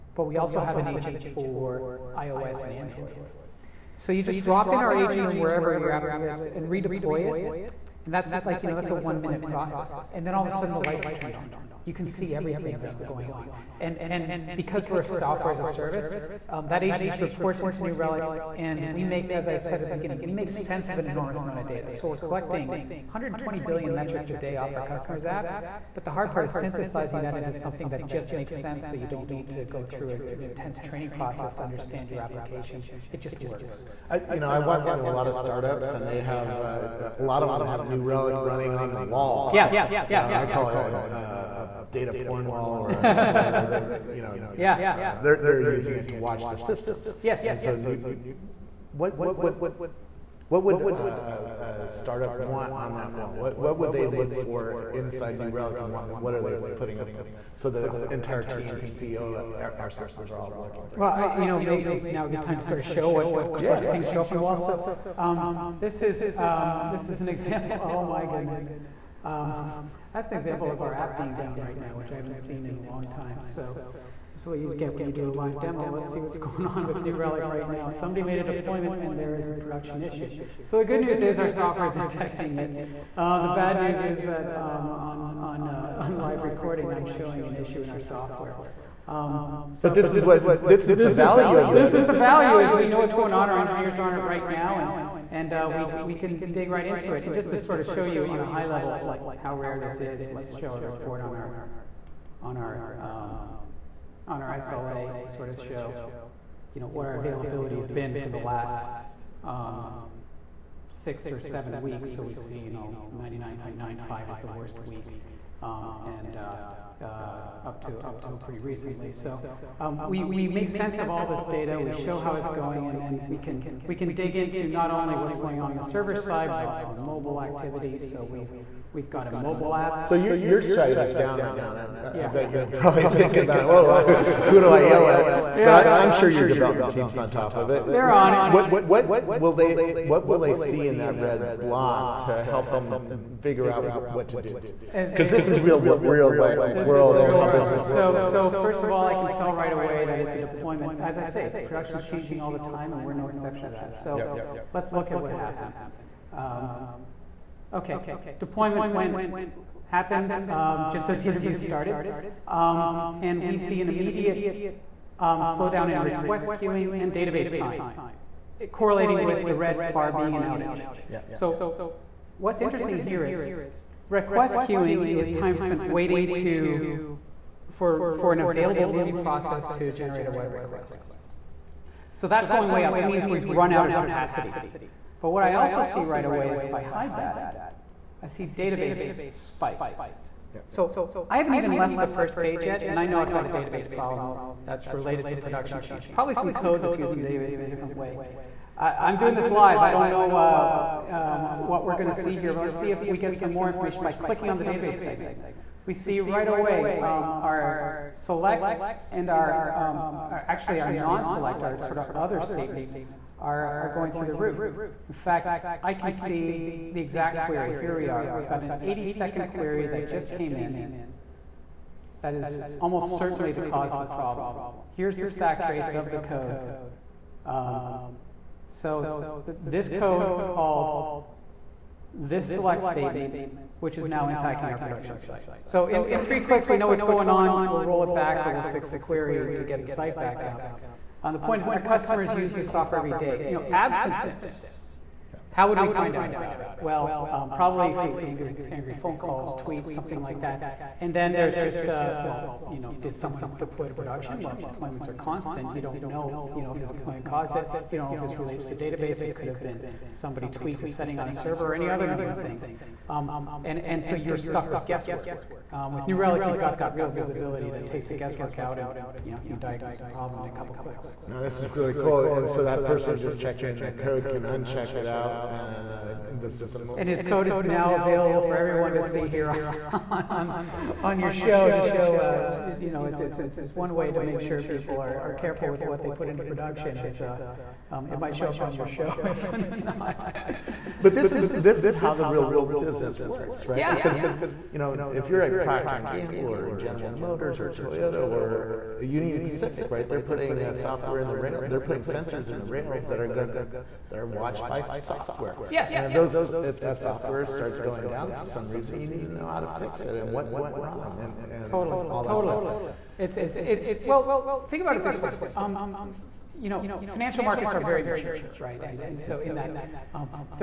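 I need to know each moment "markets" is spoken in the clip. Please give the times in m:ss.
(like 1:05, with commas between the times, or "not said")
5:17.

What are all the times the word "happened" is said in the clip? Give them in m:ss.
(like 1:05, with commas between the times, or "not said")
2:35, 2:39.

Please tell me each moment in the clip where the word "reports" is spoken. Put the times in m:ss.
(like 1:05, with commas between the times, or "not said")
0:17, 1:40.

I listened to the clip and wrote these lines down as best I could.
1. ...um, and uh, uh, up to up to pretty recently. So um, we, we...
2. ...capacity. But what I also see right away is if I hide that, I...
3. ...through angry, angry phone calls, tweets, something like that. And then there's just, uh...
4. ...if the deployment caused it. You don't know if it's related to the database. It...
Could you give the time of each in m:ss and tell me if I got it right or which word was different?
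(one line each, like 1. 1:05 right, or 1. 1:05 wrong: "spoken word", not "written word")
1. 1:55 right
2. 3:03 right
3. 4:07 right
4. 4:16 right.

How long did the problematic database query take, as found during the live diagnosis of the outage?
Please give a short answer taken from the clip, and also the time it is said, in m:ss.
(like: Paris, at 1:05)
80 seconds, at 3:38.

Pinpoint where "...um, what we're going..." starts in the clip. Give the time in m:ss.
3:21.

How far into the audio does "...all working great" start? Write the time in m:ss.
1:00.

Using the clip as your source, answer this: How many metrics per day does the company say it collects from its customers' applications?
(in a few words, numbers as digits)
120 billion.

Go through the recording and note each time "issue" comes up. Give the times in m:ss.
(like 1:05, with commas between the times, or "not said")
1:20, 1:27.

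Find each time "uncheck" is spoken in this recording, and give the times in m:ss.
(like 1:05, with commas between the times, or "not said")
4:34.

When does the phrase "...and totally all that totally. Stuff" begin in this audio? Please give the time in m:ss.
5:11.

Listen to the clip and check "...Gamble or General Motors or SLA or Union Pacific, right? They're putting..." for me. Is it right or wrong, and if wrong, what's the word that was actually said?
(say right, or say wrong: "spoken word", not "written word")
wrong: "Toyota", not "SLA".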